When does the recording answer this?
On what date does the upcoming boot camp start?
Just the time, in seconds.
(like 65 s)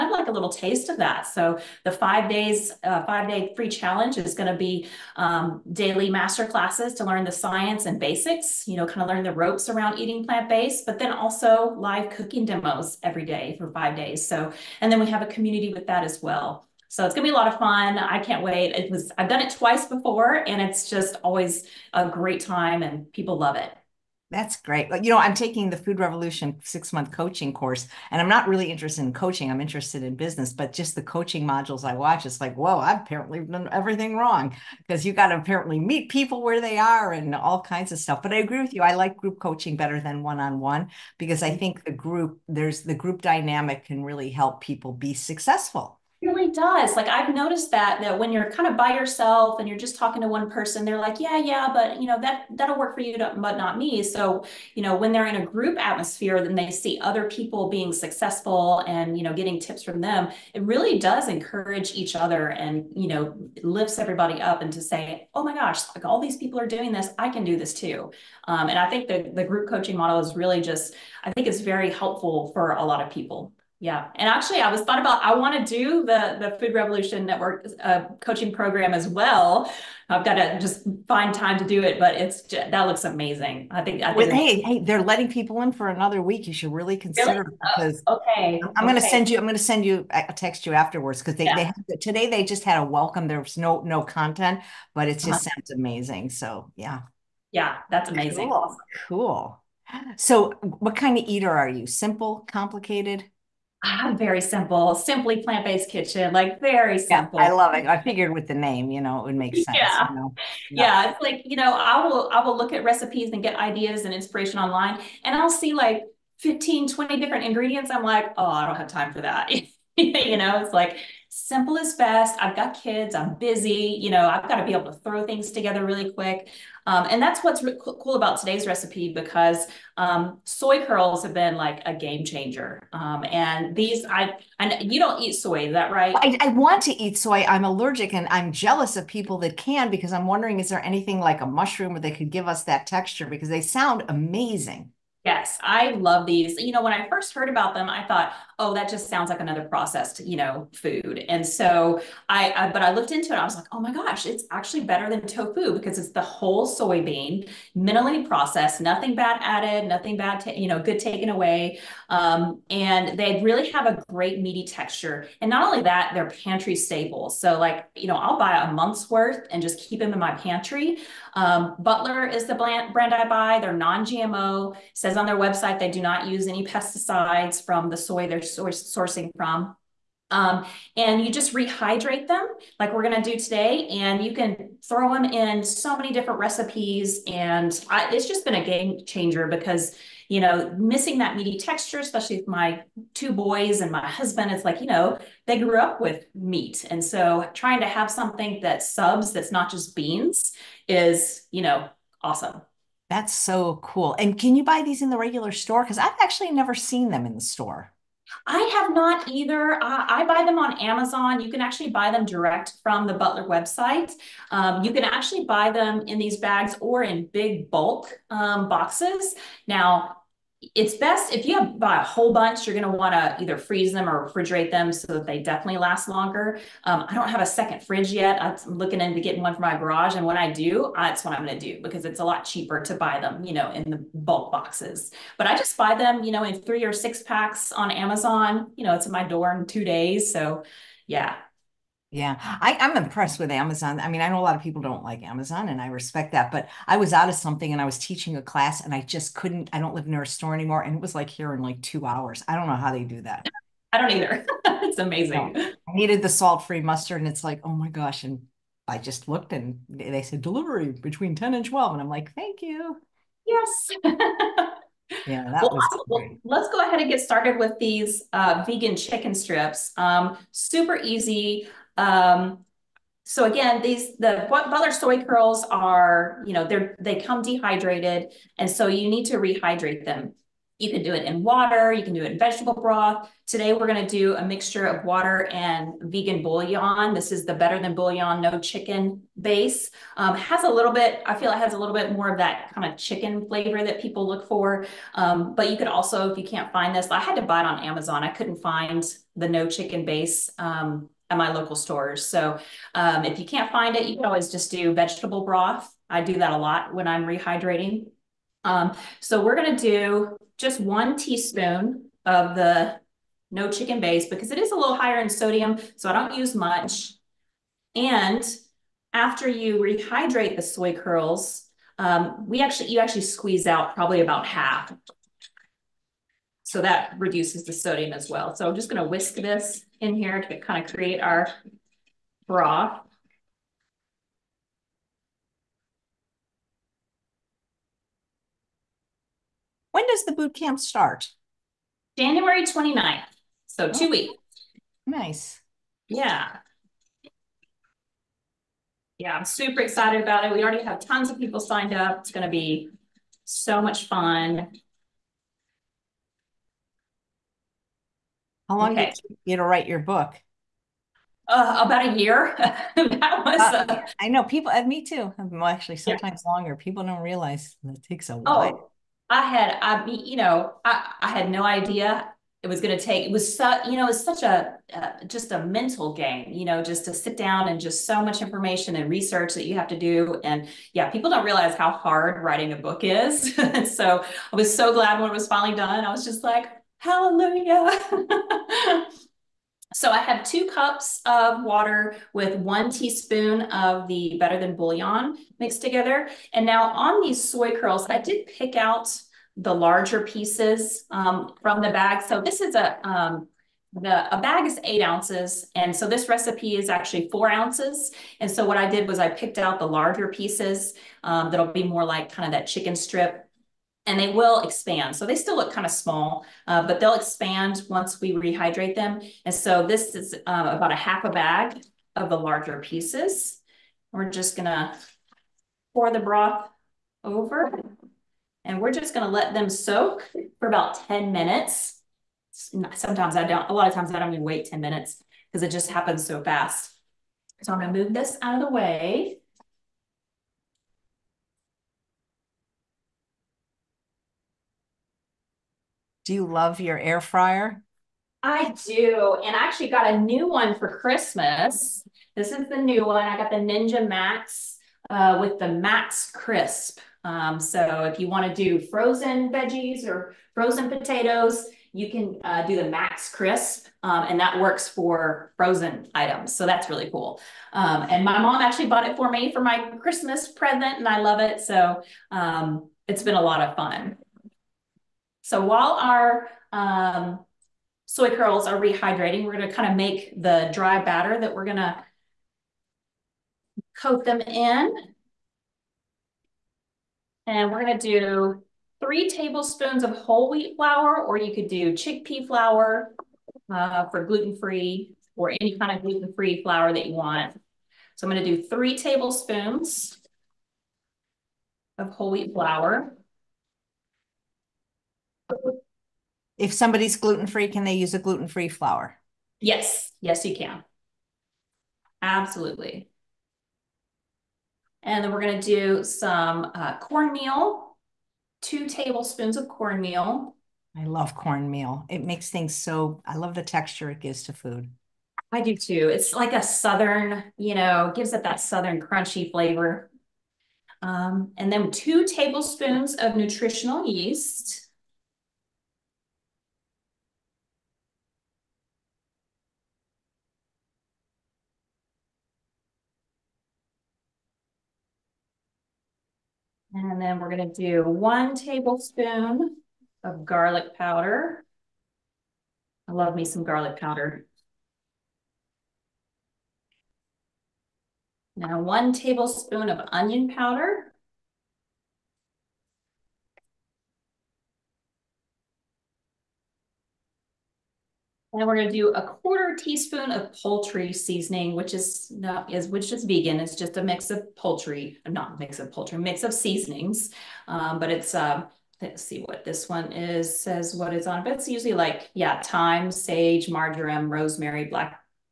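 342 s.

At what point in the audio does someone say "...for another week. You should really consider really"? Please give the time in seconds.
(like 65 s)
85 s.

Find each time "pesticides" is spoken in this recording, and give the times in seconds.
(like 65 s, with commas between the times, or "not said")
176 s.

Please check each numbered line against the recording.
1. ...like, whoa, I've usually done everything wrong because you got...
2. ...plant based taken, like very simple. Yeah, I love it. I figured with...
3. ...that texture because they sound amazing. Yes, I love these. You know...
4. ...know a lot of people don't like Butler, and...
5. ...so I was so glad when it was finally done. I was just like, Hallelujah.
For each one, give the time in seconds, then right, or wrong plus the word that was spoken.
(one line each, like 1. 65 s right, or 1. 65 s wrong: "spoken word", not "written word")
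1. 32 s wrong: "apparently", not "usually"
2. 105 s wrong: "kitchen", not "taken"
3. 142 s right
4. 244 s wrong: "Amazon", not "Butler"
5. 383 s right.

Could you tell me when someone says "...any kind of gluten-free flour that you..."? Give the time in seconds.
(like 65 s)
495 s.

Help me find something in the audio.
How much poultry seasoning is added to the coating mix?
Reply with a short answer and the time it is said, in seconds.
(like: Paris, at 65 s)
1/4 teaspoon, at 569 s.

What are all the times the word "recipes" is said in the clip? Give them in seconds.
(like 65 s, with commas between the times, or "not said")
112 s, 128 s, 186 s, 406 s.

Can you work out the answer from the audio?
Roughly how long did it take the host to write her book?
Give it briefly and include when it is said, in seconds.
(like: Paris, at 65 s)
About a year, at 361 s.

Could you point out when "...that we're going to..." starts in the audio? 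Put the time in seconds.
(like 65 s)
481 s.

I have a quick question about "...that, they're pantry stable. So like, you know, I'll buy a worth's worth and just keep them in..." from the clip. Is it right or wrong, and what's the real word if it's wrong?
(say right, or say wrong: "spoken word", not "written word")
wrong: "month", not "worth".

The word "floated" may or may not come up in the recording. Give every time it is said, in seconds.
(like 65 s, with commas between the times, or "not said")
not said.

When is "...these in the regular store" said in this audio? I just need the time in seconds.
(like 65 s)
204 s.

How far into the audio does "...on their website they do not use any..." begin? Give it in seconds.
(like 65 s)
175 s.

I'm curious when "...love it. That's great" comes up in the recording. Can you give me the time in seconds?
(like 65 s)
23 s.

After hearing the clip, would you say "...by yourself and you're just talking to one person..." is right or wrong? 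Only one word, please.
right.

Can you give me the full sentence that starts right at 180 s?
Um, and you just rehydrate them like we're going to do today.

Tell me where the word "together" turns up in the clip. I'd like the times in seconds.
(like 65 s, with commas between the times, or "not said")
125 s, 395 s.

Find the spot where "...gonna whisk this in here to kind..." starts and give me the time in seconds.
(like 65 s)
328 s.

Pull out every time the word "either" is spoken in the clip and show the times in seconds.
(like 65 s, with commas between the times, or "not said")
209 s, 223 s, 254 s.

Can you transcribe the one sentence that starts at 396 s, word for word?
And now on these soy curls, I did pick out the larger pieces um, from the bag.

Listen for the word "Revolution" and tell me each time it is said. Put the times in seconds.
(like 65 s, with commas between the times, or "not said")
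25 s, 76 s.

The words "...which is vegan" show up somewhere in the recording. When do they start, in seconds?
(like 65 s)
572 s.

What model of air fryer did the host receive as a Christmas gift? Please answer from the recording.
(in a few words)
Ninja Max.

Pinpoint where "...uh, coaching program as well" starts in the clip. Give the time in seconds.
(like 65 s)
77 s.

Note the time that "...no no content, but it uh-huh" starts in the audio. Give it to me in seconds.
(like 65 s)
93 s.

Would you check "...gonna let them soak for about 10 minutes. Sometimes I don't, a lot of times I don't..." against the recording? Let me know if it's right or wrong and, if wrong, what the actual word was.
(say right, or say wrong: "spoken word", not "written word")
right.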